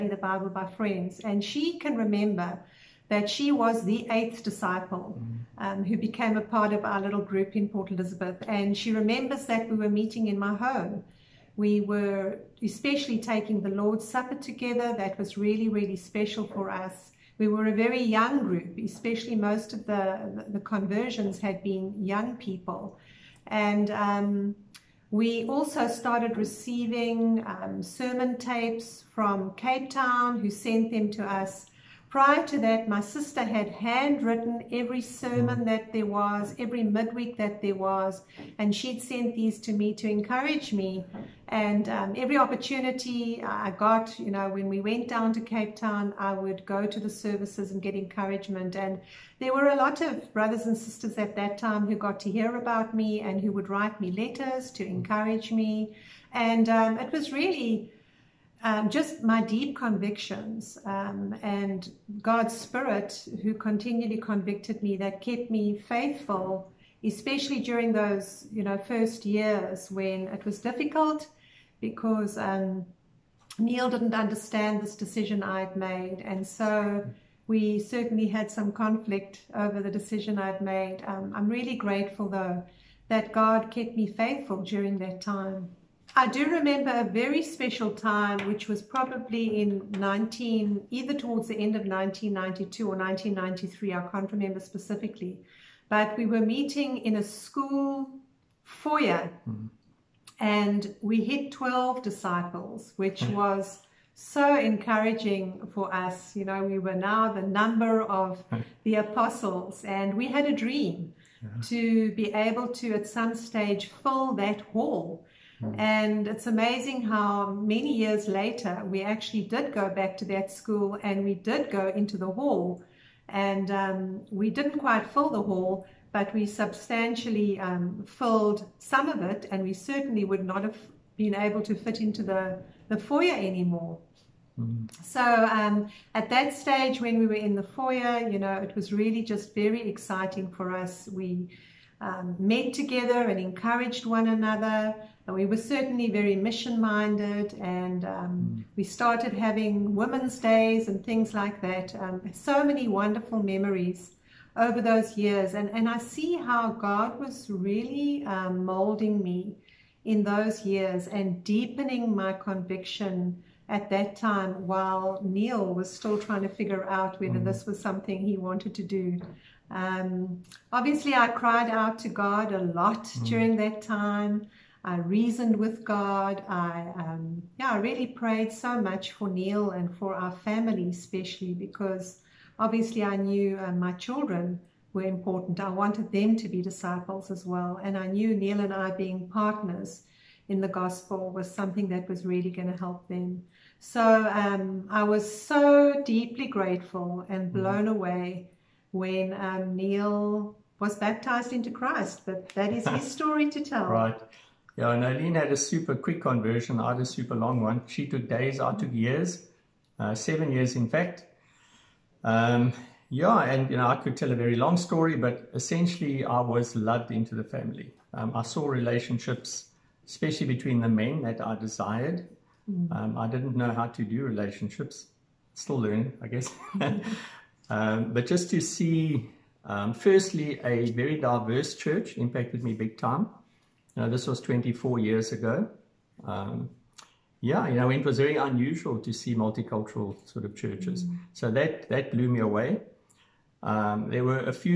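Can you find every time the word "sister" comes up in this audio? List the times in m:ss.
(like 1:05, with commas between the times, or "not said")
0:32, 0:50.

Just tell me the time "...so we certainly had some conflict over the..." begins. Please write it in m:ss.
1:16.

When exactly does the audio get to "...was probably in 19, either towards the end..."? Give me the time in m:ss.
1:28.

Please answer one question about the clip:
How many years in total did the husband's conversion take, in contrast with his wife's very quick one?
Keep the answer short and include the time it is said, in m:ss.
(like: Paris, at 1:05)
7, at 3:30.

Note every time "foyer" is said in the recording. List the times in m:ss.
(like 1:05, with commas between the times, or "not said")
1:38, 2:12, 2:17.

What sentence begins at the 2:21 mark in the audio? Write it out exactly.
We um, met together and encouraged one another.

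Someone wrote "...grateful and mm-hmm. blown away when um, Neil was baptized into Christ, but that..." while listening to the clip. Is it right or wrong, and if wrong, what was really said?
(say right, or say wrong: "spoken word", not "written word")
right.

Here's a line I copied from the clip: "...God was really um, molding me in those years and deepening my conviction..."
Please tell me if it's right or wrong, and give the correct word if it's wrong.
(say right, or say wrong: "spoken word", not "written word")
right.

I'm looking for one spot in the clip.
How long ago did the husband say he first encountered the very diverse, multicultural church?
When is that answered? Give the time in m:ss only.
3:54.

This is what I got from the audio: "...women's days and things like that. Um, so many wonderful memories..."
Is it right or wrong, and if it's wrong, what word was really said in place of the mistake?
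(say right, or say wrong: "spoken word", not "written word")
right.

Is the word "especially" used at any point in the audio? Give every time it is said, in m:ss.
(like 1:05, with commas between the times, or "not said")
0:12, 0:18, 1:07, 3:00, 3:40.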